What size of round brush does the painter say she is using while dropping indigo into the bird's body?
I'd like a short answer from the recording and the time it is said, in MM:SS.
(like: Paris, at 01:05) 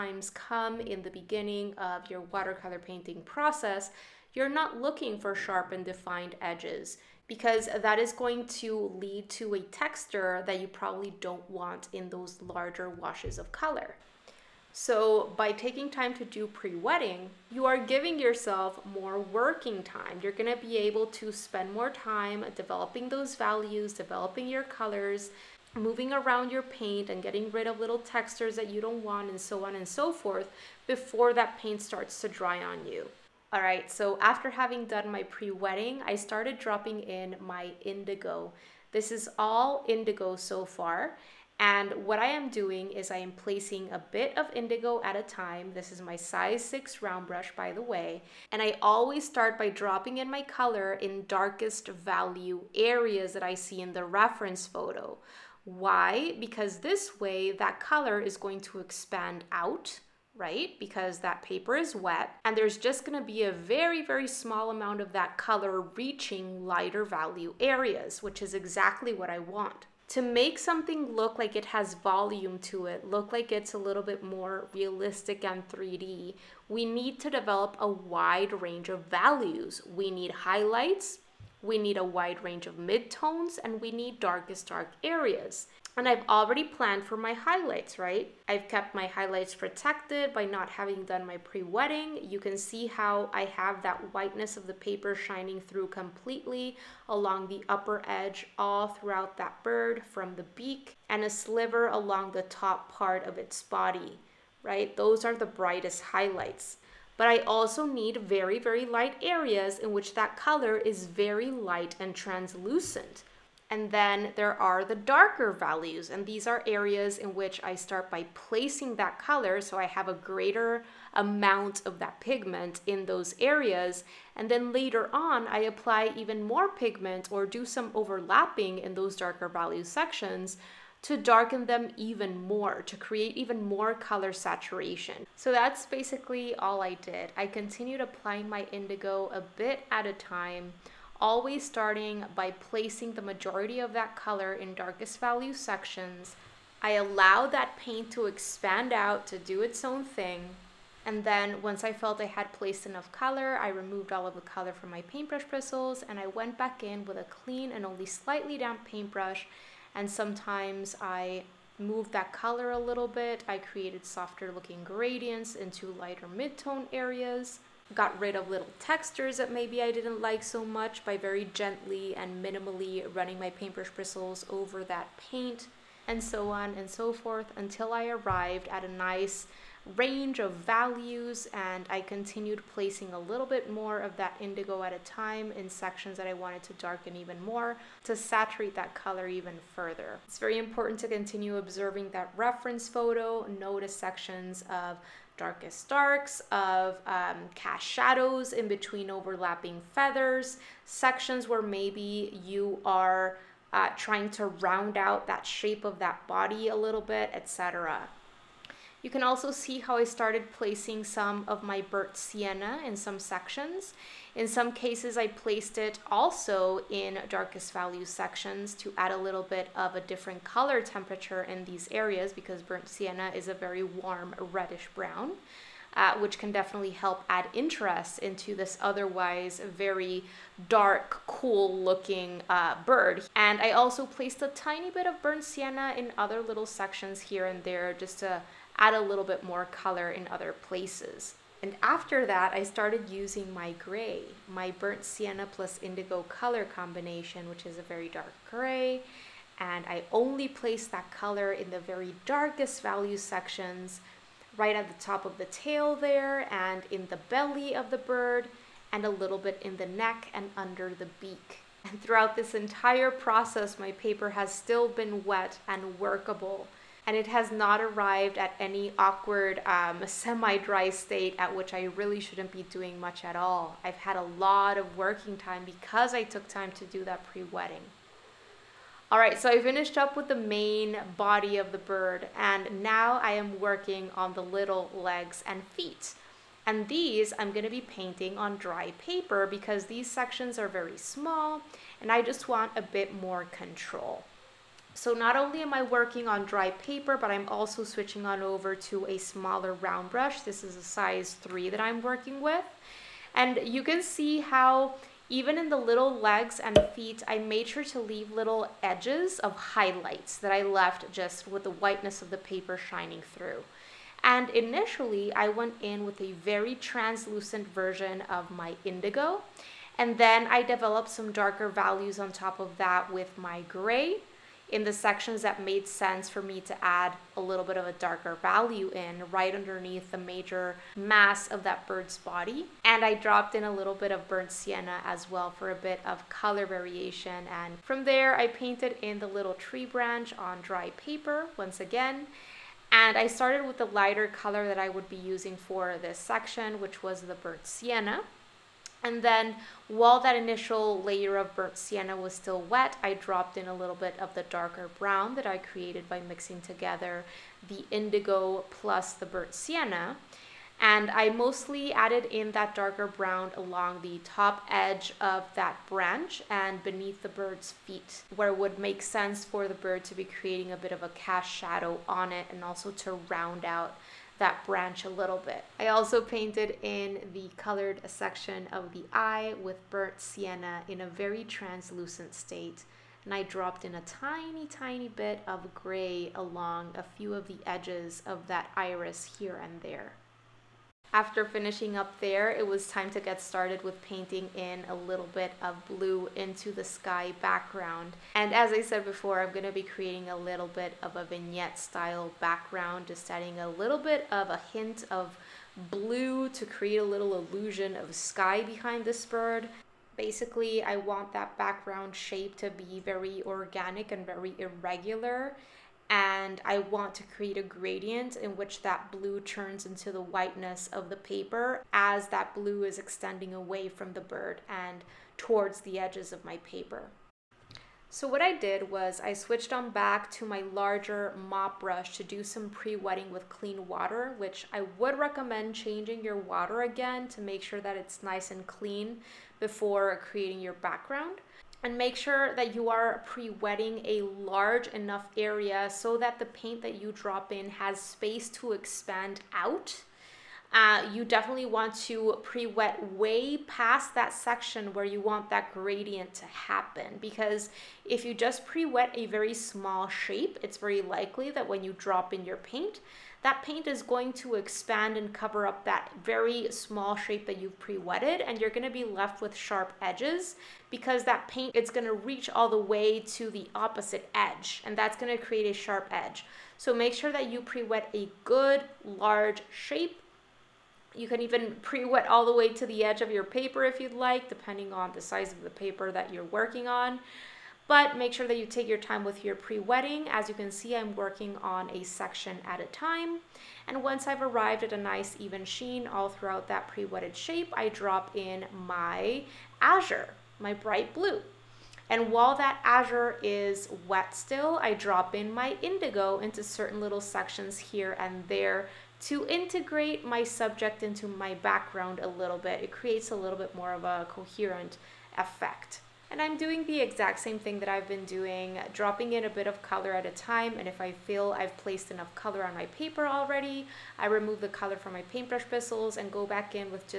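6, at 00:46.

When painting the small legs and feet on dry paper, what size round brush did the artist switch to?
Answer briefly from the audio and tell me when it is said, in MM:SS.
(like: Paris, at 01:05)
3, at 05:00.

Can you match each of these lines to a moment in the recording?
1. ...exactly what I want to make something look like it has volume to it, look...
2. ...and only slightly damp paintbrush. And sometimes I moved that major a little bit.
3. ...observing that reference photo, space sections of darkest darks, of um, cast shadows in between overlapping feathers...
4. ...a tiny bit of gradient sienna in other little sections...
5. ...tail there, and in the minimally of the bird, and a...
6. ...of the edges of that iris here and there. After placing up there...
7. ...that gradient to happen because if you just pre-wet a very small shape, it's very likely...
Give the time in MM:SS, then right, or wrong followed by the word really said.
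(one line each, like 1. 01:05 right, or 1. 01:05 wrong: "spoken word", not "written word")
1. 01:08 right
2. 02:37 wrong: "color", not "major"
3. 03:11 wrong: "notice", not "space"
4. 03:54 wrong: "burnt", not "gradient"
5. 04:15 wrong: "belly", not "minimally"
6. 06:27 wrong: "finishing", not "placing"
7. 07:35 right.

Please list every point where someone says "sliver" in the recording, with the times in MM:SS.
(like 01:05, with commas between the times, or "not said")
01:41.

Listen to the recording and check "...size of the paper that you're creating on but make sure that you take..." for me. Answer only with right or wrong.
wrong.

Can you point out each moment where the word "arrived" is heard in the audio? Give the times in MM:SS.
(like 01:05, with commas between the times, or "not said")
02:58, 04:27, 08:14.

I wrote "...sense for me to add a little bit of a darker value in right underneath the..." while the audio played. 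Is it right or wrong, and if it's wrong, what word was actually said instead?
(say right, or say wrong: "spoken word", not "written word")
right.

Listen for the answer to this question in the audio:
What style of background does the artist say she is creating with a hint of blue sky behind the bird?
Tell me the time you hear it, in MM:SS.
06:41.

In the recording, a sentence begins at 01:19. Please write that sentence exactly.
We need highlights, we need a wide range of midtones, and we need darkest dark areas.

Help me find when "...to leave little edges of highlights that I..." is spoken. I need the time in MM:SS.
05:07.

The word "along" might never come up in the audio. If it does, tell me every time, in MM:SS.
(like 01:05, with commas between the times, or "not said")
01:37, 01:41, 06:03, 06:26.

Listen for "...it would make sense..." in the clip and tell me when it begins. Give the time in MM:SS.
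06:08.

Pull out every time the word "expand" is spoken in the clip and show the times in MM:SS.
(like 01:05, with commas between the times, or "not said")
00:58, 02:28, 07:28, 07:44.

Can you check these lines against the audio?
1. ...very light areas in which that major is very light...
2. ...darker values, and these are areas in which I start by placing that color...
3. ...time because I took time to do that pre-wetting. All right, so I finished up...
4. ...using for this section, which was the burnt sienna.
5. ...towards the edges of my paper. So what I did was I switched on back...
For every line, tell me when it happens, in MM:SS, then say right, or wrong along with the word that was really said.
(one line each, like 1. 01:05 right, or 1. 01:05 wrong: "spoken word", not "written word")
1. 01:48 wrong: "color", not "major"
2. 01:54 right
3. 04:35 right
4. 05:45 right
5. 07:05 right.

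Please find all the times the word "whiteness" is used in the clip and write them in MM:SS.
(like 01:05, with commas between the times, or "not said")
01:34, 05:11, 07:00.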